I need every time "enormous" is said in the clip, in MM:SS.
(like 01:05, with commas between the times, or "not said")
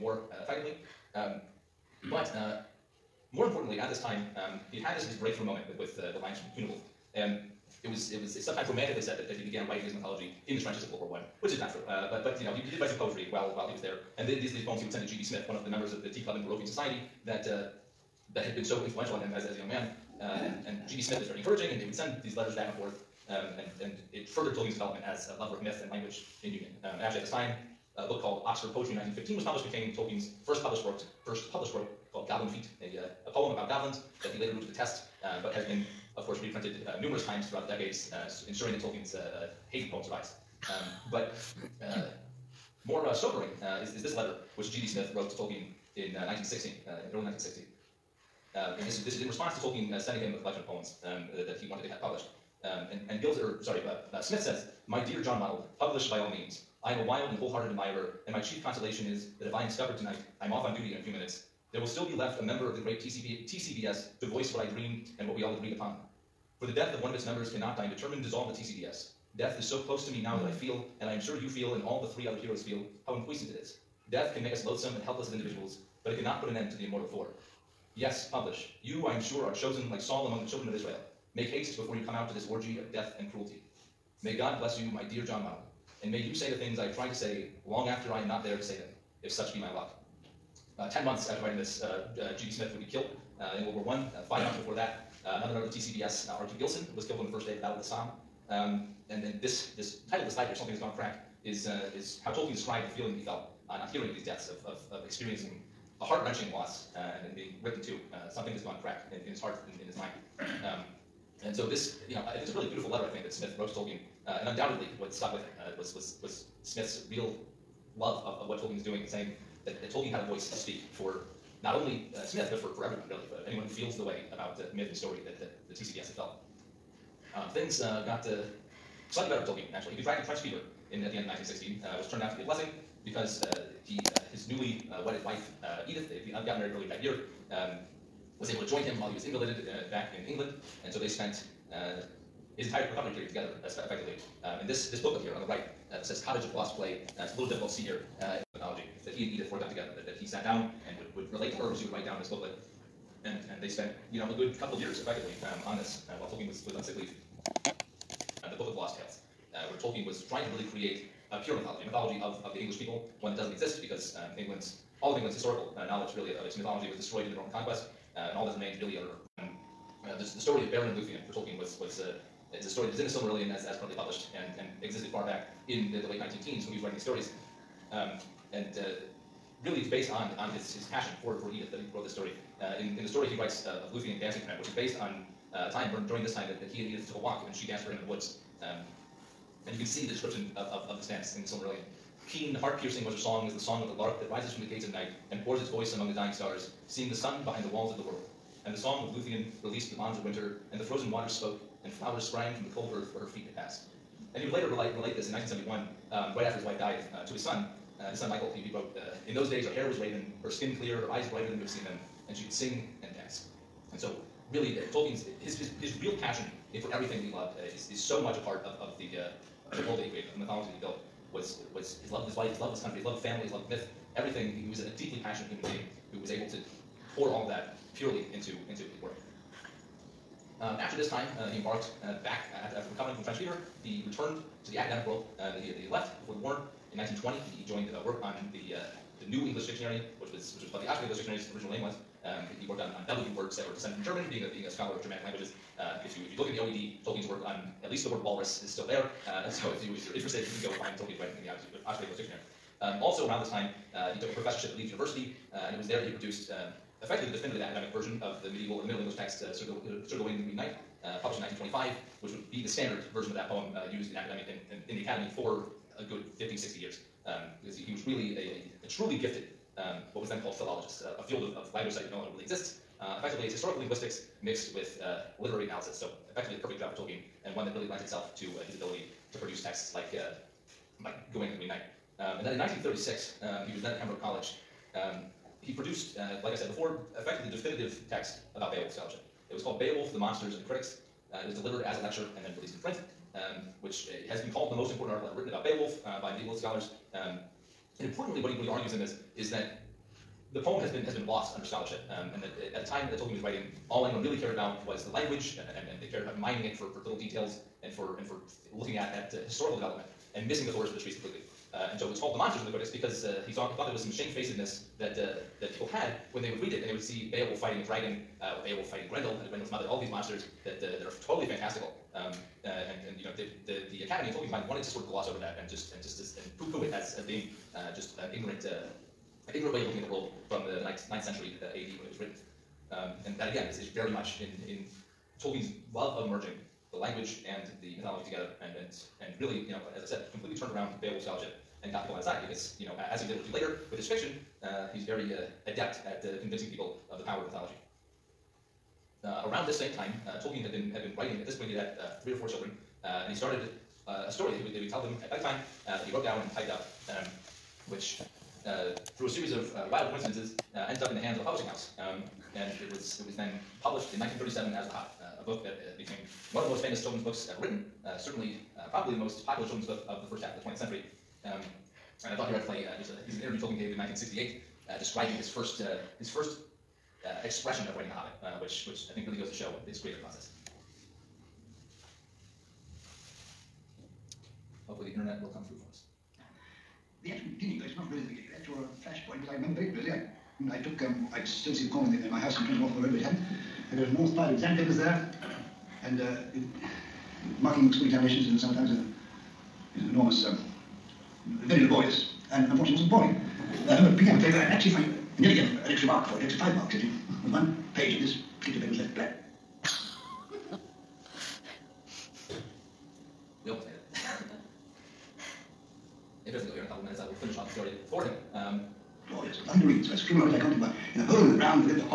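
06:34, 06:40.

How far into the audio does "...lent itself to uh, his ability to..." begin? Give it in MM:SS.
04:37.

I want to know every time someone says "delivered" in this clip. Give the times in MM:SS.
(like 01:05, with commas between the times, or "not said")
04:51.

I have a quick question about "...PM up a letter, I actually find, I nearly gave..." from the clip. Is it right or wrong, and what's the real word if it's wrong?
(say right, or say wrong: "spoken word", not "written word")
wrong: "paper", not "letter".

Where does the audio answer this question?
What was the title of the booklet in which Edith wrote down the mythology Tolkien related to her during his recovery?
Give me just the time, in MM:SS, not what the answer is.
02:26.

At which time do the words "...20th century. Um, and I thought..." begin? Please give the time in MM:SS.
06:10.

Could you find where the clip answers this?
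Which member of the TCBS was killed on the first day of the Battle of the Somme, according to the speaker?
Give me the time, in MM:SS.
01:36.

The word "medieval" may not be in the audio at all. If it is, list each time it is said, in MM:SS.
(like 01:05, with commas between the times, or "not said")
04:18, 04:56.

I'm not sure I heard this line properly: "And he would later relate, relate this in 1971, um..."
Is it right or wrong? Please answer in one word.
right.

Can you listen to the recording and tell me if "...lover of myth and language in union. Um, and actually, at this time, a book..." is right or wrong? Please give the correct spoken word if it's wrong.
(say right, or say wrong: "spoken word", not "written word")
right.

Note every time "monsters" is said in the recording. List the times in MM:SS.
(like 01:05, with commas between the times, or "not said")
04:50, 05:12, 05:20.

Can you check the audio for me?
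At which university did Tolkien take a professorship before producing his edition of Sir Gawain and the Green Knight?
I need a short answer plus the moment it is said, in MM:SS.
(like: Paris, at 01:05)
Leeds University, at 04:14.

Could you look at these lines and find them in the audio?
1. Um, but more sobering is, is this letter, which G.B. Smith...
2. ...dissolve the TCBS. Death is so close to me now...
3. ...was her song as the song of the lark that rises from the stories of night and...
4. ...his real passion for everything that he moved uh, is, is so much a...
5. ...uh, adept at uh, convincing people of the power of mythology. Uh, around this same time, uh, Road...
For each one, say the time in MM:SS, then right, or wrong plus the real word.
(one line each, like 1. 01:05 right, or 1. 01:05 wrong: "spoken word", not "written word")
1. 00:40 right
2. 01:08 right
3. 03:13 wrong: "gates", not "stories"
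4. 03:35 wrong: "loved", not "moved"
5. 05:45 wrong: "Tolkien", not "Road".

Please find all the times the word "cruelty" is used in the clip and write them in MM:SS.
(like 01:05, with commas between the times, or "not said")
01:23.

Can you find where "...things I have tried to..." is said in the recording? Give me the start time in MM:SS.
01:26.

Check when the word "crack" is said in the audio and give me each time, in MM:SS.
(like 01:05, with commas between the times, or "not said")
01:40, 01:48.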